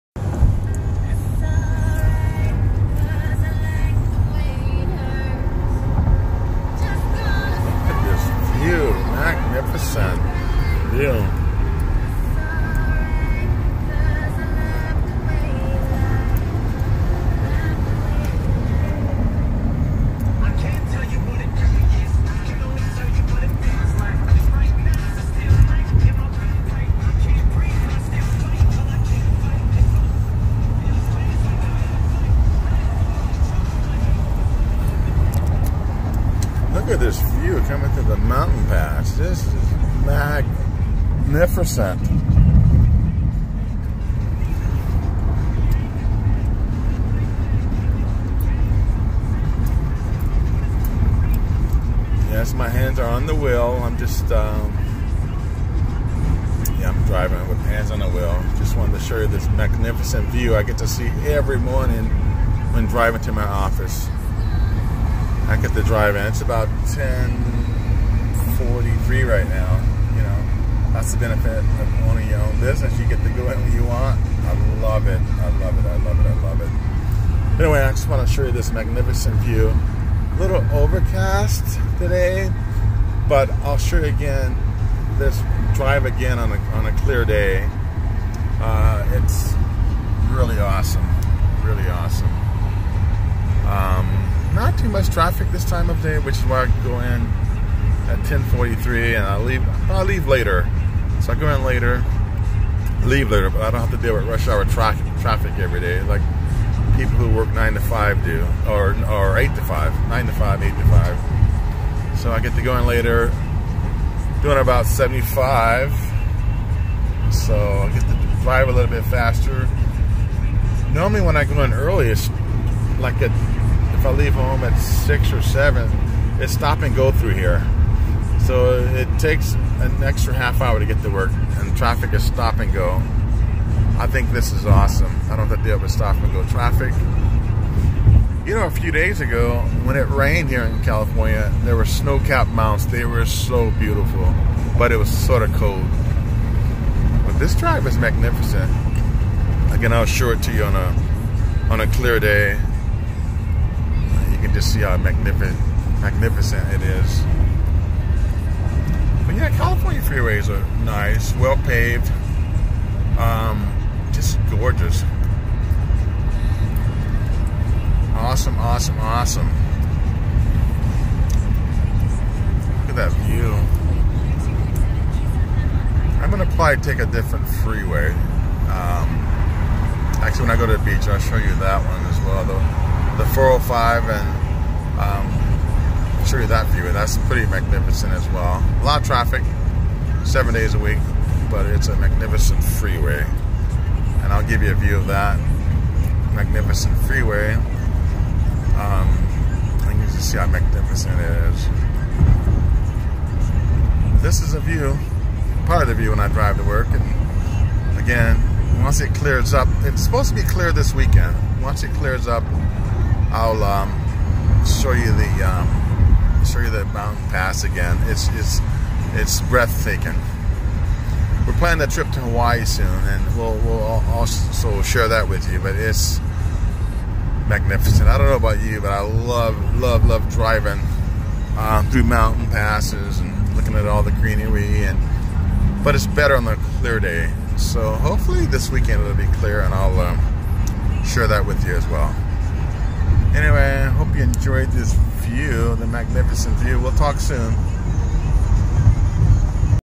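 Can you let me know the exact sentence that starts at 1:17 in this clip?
Anyway, I just want to show you this magnificent view.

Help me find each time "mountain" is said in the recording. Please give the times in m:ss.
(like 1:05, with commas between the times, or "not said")
0:38, 2:22, 3:36, 3:52.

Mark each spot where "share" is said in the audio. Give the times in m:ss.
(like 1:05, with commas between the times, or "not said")
3:44, 4:01.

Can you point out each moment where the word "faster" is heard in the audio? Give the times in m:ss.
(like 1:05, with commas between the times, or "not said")
1:59.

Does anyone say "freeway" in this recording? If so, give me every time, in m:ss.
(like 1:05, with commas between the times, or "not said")
2:40, 2:57, 3:12, 3:17.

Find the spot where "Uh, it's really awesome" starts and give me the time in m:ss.
1:28.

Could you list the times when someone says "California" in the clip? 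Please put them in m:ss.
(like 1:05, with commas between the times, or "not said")
2:20, 2:39.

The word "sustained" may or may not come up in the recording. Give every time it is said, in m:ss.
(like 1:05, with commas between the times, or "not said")
not said.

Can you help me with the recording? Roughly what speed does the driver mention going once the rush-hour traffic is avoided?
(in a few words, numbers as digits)
75.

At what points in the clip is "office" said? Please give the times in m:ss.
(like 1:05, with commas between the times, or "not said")
1:03.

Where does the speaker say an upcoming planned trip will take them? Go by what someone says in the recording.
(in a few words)
Hawaii.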